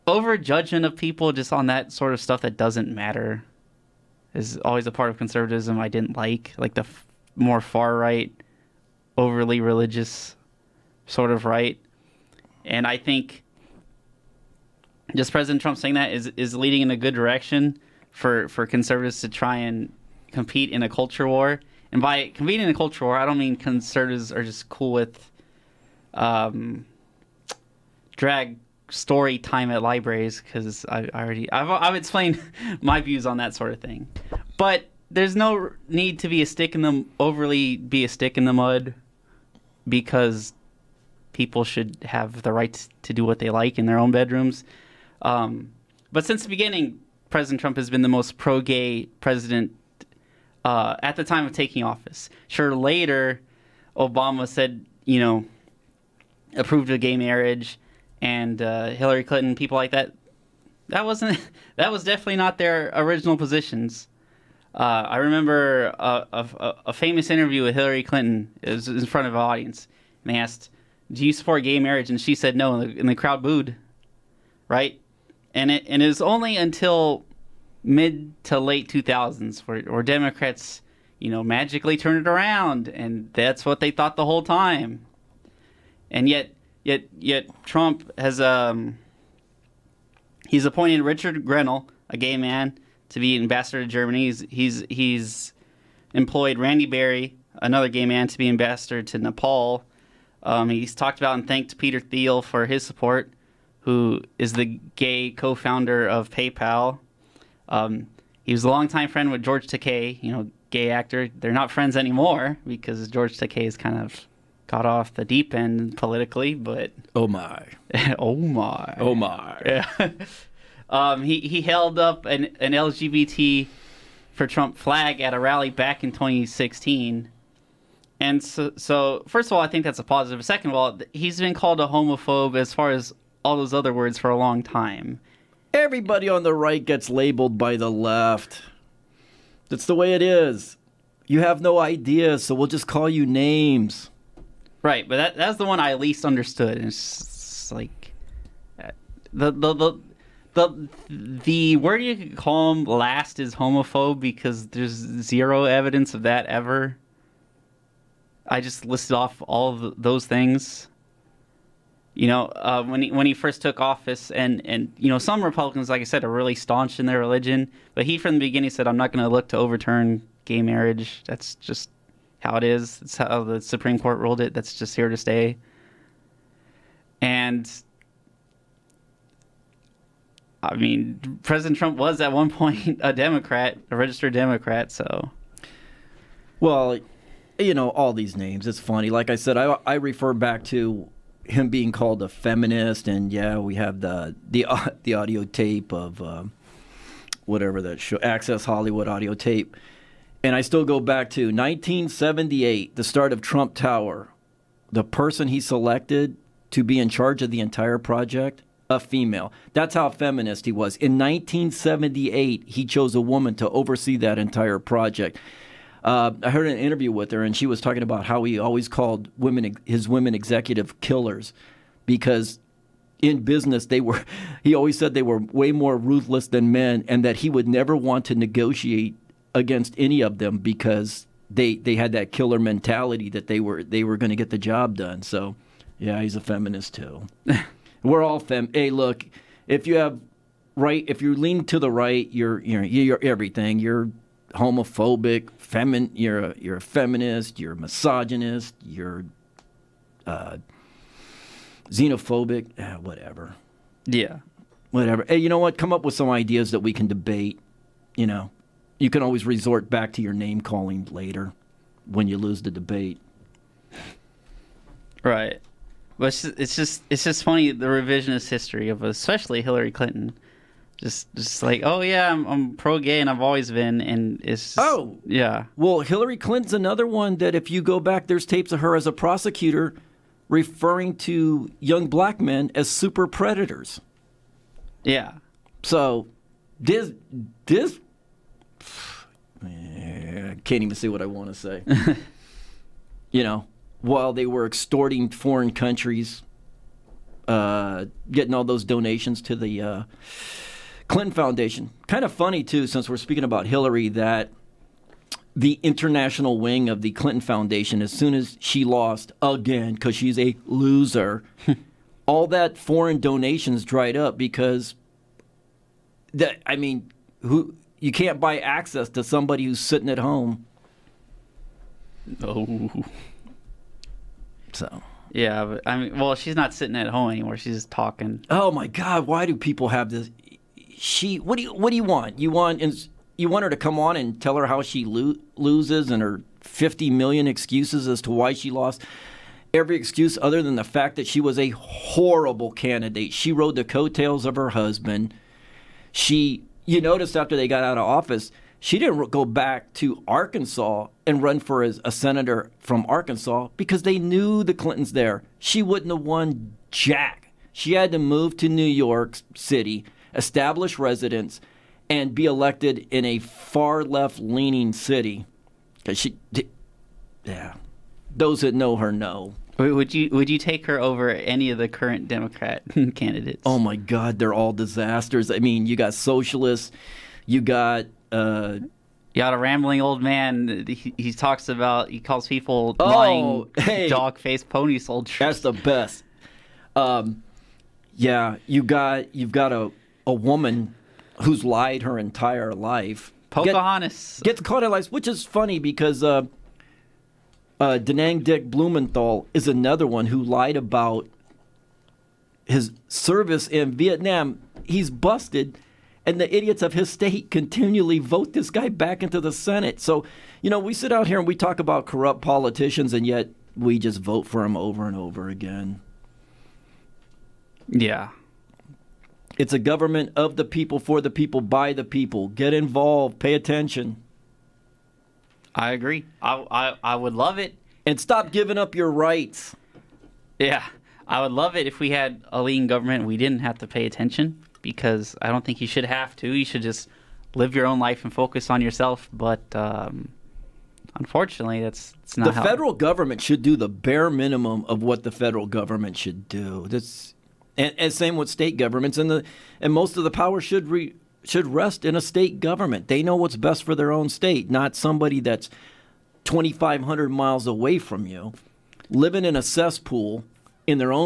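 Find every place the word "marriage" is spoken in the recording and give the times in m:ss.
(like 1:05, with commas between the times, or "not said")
0:57, 1:11, 2:50.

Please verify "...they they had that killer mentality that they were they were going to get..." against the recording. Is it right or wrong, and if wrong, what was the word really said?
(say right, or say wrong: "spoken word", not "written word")
right.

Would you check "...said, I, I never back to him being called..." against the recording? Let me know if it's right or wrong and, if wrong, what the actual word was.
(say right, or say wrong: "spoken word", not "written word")
wrong: "refer", not "never".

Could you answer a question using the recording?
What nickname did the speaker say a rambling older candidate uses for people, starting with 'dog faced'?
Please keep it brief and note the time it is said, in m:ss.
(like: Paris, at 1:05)
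pony soldiers, at 6:24.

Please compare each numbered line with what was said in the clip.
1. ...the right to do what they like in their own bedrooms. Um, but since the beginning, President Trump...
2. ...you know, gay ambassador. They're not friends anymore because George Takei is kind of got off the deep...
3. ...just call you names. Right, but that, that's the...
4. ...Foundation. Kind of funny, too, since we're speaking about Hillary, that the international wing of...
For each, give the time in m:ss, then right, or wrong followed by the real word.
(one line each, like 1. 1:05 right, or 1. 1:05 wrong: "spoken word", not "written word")
1. 0:42 right
2. 1:50 wrong: "actor", not "ambassador"
3. 2:22 right
4. 5:01 right.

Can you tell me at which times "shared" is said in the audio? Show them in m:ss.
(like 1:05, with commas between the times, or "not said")
not said.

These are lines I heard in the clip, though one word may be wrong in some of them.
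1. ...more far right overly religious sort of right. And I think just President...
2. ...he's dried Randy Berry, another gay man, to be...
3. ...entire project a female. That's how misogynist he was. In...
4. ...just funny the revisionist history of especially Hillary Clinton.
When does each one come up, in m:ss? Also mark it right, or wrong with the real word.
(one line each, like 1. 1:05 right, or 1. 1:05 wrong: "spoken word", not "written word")
1. 0:07 right
2. 1:34 wrong: "employed", not "dried"
3. 3:27 wrong: "feminist", not "misogynist"
4. 4:27 right.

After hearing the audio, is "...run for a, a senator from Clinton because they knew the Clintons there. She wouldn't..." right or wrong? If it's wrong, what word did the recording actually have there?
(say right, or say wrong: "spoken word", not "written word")
wrong: "Arkansas", not "Clinton".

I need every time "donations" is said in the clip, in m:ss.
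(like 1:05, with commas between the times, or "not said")
4:58, 5:13.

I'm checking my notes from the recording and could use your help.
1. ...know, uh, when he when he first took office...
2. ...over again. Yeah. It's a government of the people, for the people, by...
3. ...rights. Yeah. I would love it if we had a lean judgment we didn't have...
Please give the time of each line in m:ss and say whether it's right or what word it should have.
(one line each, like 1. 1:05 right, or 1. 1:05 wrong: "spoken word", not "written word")
1. 2:42 right
2. 6:55 right
3. 7:09 wrong: "government", not "judgment".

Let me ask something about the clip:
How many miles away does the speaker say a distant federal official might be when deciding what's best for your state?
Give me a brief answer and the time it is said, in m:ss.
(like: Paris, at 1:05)
2,500, at 7:36.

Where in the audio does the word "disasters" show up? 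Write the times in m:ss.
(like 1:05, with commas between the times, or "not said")
6:14.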